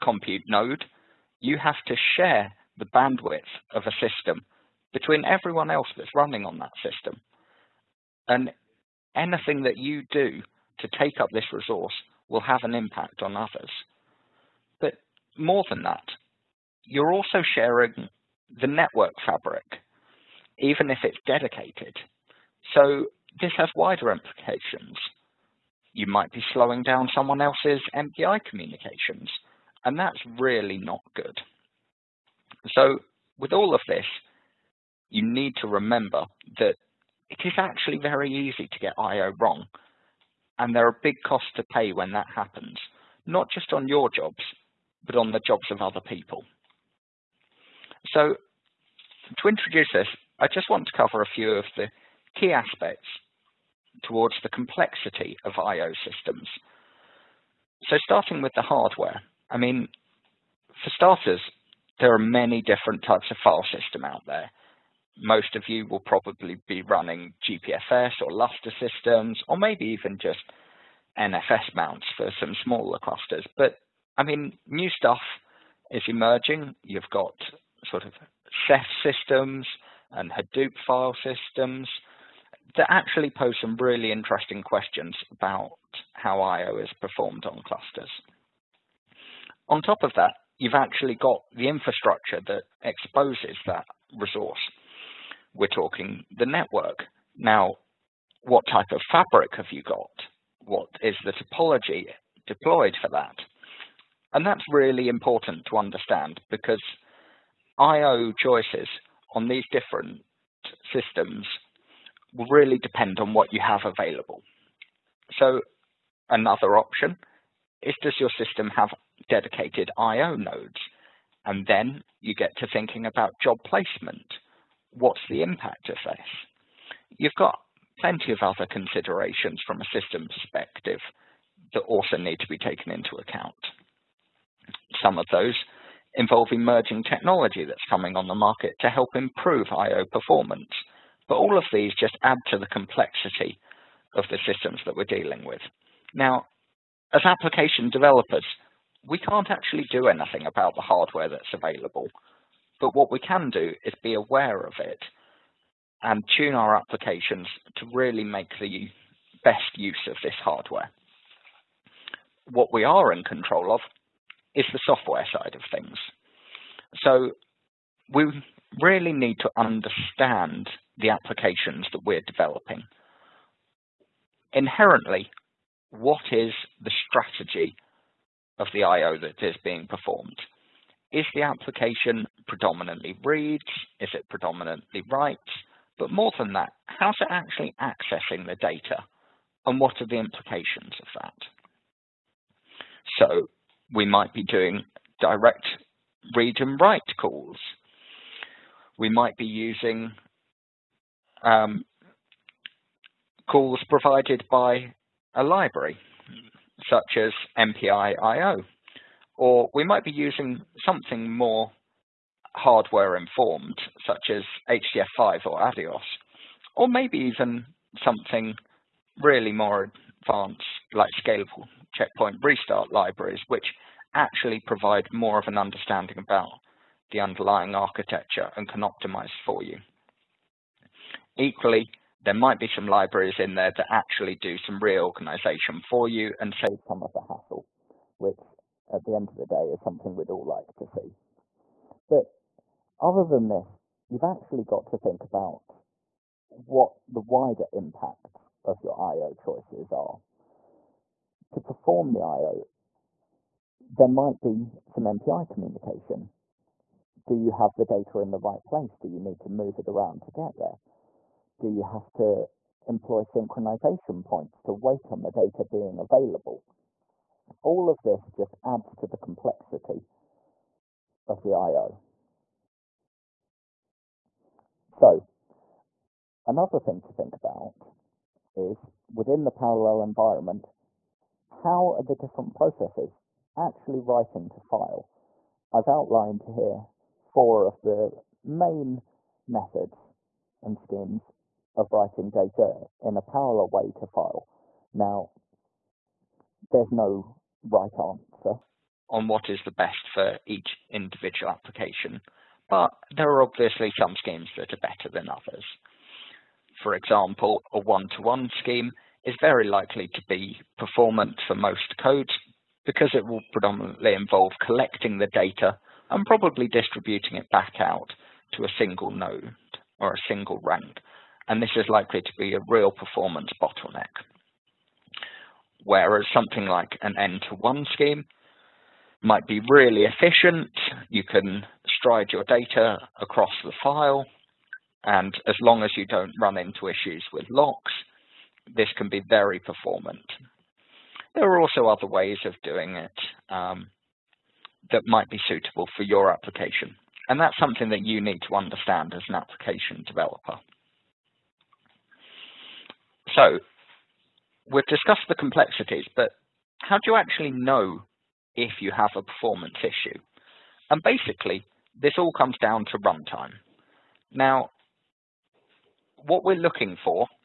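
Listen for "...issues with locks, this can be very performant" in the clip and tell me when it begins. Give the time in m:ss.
5:36.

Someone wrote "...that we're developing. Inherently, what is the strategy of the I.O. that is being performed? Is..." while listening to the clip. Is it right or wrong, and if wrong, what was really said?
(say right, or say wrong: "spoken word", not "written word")
right.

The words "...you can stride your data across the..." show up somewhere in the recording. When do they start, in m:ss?
5:31.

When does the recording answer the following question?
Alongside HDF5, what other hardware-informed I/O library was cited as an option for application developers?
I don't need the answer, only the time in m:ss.
3:35.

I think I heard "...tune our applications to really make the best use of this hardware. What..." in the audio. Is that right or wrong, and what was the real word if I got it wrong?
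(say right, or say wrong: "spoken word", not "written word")
right.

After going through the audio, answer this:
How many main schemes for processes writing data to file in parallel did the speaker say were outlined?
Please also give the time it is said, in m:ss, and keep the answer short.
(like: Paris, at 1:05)
4, at 4:47.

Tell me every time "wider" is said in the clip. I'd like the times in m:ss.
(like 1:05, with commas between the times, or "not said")
0:23, 4:07.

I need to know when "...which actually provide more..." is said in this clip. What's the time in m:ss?
3:43.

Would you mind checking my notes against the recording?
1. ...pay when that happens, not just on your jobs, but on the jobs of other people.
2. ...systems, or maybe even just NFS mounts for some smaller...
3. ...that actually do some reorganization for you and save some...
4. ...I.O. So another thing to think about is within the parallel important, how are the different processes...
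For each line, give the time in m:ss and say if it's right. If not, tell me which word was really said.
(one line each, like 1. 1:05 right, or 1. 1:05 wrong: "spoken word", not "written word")
1. 0:41 right
2. 1:08 right
3. 3:53 right
4. 4:31 wrong: "environment", not "important".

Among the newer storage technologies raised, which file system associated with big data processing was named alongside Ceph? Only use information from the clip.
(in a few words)
Hadoop.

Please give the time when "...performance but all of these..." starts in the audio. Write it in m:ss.
2:20.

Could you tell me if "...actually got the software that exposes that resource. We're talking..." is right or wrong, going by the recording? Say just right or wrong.
wrong.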